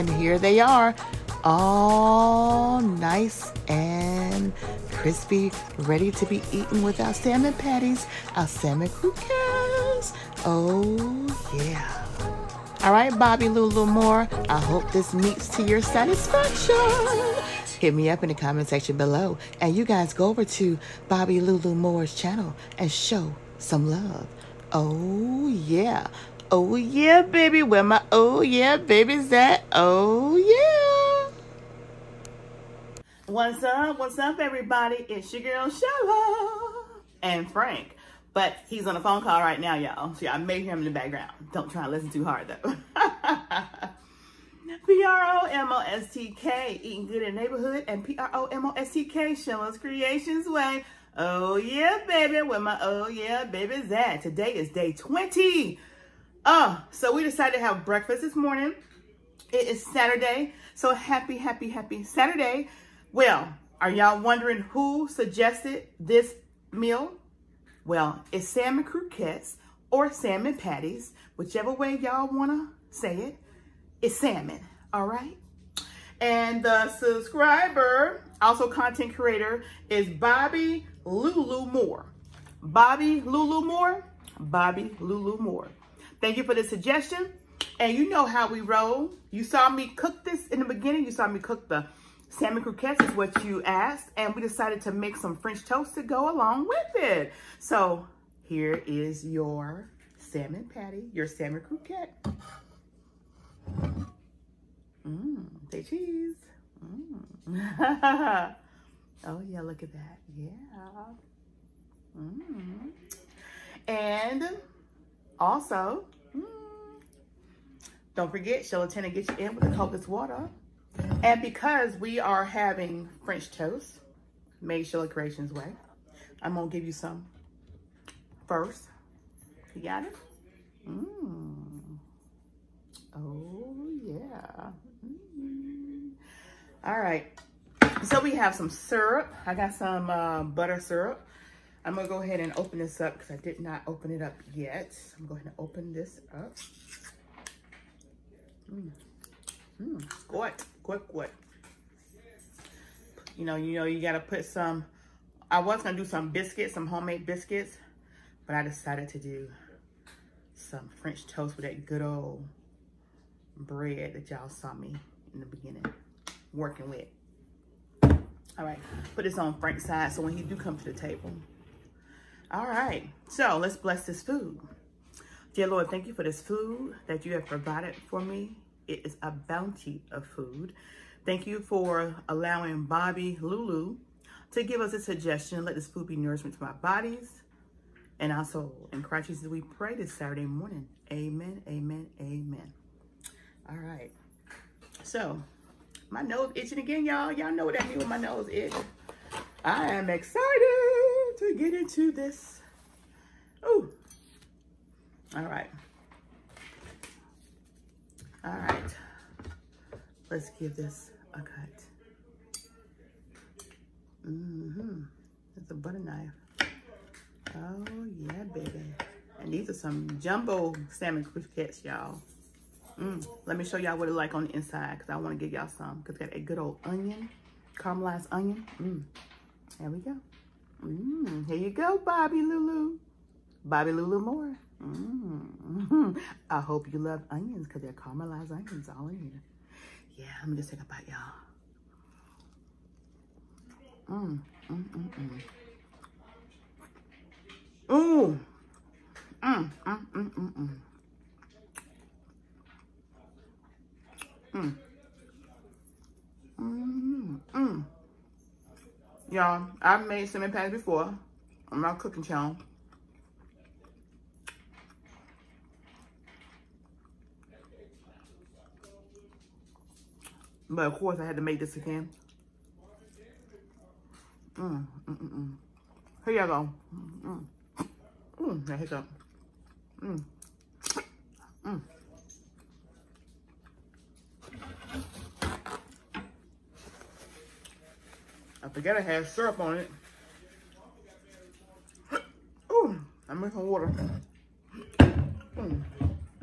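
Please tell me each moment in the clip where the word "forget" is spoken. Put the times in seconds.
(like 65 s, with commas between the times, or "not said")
118 s, 288 s.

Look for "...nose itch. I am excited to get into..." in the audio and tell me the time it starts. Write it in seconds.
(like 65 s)
198 s.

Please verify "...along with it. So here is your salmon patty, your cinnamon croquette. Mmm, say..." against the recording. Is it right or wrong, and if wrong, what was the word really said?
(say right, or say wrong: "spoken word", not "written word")
wrong: "salmon", not "cinnamon".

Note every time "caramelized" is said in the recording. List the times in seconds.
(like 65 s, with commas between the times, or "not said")
227 s, 237 s.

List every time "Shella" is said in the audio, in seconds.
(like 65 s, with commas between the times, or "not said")
35 s, 49 s.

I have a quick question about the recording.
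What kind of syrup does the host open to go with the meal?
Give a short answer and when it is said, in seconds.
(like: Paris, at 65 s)
butter syrup, at 140 s.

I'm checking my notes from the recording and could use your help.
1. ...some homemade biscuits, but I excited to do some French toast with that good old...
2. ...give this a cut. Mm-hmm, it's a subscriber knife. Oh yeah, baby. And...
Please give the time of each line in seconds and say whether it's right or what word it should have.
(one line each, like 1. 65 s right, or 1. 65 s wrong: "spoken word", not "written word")
1. 156 s wrong: "decided", not "excited"
2. 210 s wrong: "butter", not "subscriber".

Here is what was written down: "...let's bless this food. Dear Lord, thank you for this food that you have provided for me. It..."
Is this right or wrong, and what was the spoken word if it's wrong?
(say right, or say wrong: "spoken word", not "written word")
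right.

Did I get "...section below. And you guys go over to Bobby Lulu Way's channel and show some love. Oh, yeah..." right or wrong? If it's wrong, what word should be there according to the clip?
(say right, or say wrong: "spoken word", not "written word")
wrong: "Moore", not "Way".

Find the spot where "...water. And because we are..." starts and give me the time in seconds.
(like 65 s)
120 s.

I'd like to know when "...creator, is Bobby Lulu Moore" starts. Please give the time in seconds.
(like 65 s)
79 s.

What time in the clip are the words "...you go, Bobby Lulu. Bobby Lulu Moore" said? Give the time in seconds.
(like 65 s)
231 s.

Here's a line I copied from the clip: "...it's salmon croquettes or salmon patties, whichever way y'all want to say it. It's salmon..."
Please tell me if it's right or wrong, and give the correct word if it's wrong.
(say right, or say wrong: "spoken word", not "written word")
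right.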